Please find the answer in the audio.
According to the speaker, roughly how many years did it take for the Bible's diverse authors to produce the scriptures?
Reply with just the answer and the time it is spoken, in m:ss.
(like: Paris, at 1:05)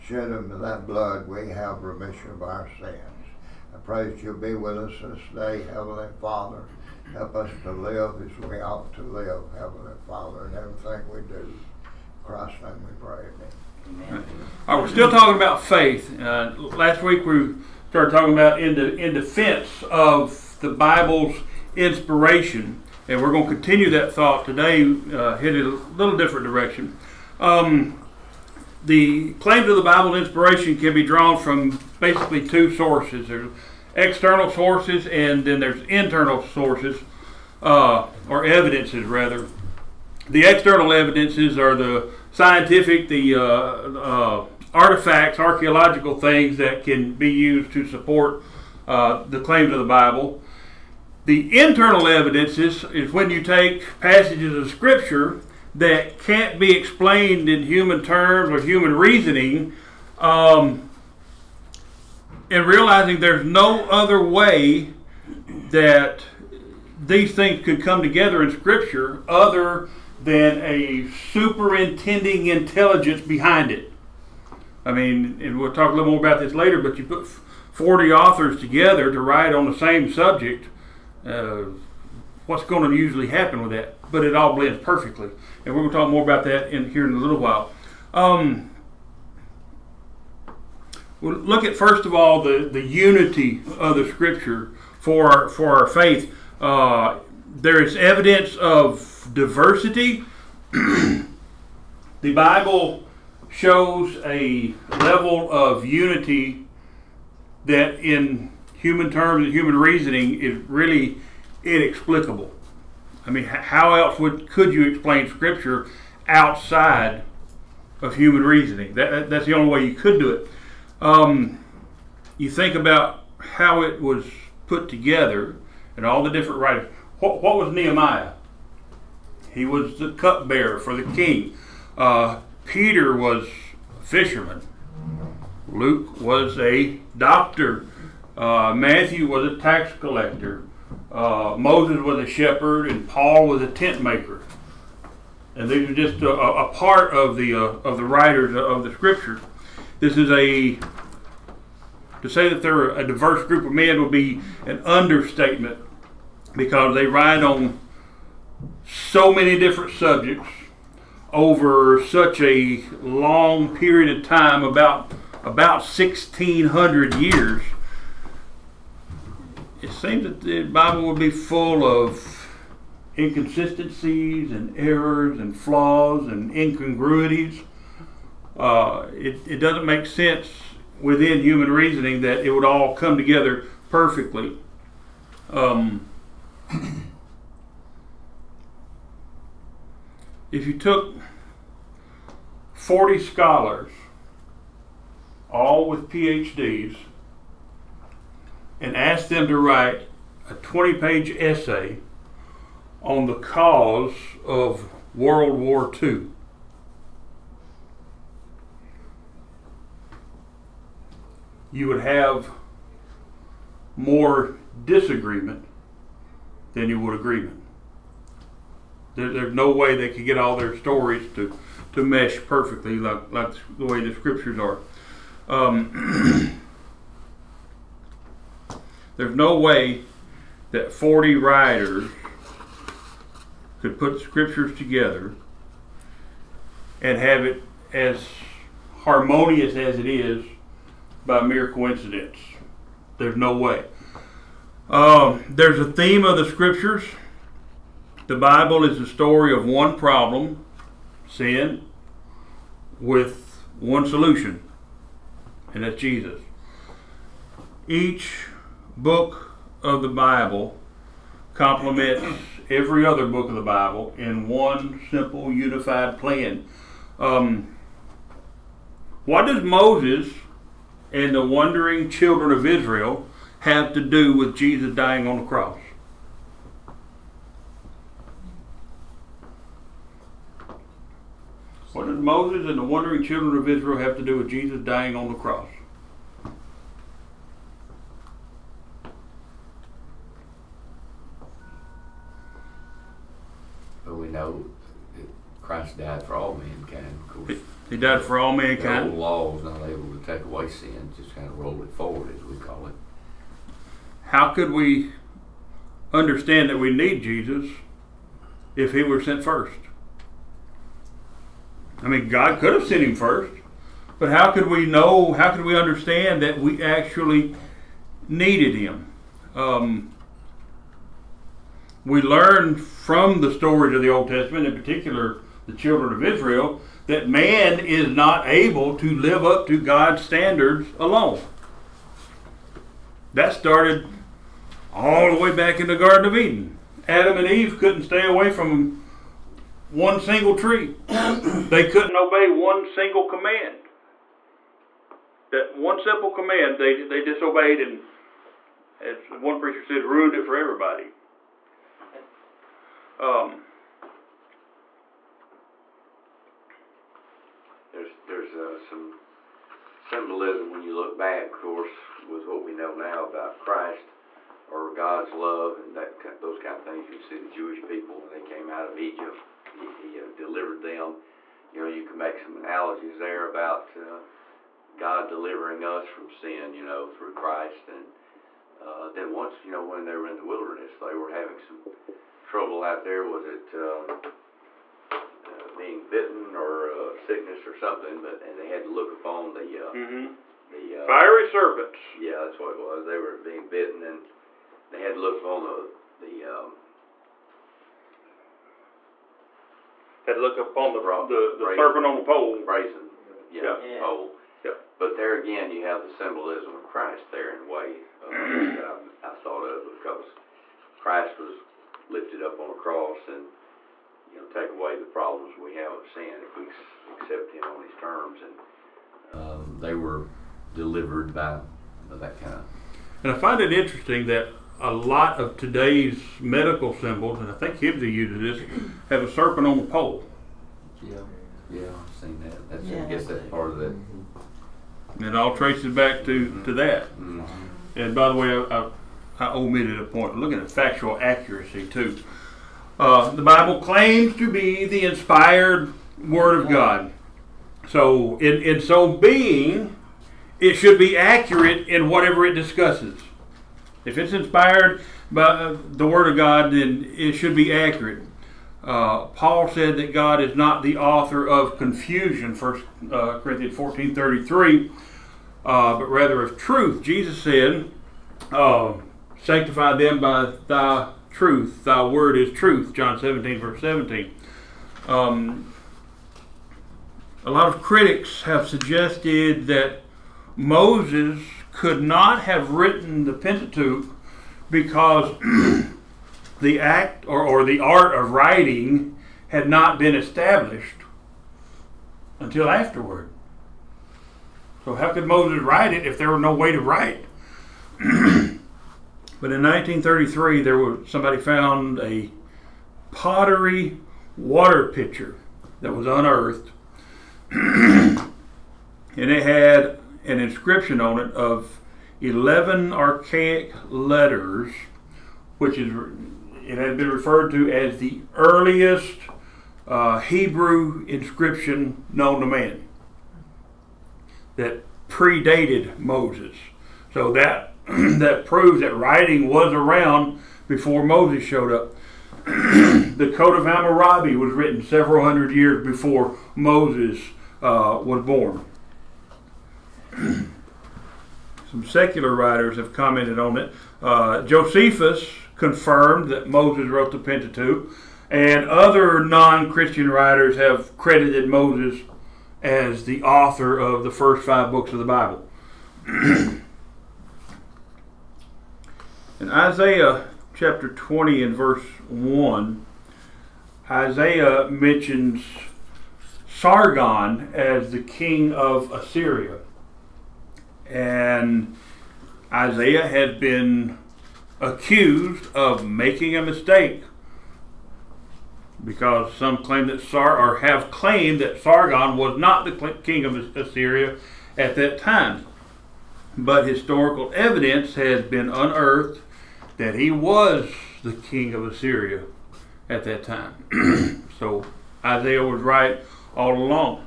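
1600, at 2:45.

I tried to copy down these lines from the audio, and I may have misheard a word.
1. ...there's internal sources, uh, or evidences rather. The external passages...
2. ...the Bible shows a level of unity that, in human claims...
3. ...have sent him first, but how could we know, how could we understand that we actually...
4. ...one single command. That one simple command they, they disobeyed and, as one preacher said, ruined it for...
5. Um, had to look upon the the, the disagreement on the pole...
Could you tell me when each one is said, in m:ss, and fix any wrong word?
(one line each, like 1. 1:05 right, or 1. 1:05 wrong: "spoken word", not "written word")
1. 0:35 wrong: "evidences", not "passages"
2. 1:40 wrong: "terms", not "claims"
3. 5:12 right
4. 5:42 right
5. 6:36 wrong: "serpent", not "disagreement".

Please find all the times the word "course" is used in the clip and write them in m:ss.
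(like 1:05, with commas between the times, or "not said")
4:57, 6:01.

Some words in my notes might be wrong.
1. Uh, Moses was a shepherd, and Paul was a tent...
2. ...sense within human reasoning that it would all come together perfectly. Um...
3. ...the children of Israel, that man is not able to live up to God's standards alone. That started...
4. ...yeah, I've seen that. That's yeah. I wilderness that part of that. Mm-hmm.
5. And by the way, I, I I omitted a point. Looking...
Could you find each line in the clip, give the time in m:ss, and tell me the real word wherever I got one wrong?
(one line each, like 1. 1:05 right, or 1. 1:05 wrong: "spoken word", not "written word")
1. 2:21 right
2. 3:00 right
3. 5:25 right
4. 7:11 wrong: "guess", not "wilderness"
5. 7:17 right.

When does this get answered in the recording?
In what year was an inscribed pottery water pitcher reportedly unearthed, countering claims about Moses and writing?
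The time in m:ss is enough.
8:19.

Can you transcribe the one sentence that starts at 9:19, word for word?
In Isaiah chapter 20 and verse 1, Isaiah mentions Sargon as the king of Assyria.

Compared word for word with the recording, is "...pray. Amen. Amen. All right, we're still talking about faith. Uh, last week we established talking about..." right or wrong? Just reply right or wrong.
wrong.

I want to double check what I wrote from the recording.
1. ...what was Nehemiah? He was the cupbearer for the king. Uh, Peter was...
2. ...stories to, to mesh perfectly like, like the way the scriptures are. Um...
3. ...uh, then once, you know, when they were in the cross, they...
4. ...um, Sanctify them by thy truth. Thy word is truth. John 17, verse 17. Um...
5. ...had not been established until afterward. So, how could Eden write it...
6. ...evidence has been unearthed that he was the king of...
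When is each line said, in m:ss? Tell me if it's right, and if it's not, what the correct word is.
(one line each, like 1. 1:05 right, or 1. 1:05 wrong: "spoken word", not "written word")
1. 2:07 right
2. 3:40 right
3. 6:18 wrong: "wilderness", not "cross"
4. 7:48 right
5. 8:09 wrong: "Moses", not "Eden"
6. 9:47 right.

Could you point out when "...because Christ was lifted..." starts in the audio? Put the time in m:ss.
6:49.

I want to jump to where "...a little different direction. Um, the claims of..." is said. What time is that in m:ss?
0:25.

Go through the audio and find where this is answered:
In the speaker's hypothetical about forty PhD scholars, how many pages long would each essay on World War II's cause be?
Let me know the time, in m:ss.
3:20.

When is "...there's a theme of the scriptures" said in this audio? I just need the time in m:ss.
4:05.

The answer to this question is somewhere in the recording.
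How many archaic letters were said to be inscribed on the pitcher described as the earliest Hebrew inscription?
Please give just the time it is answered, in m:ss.
8:32.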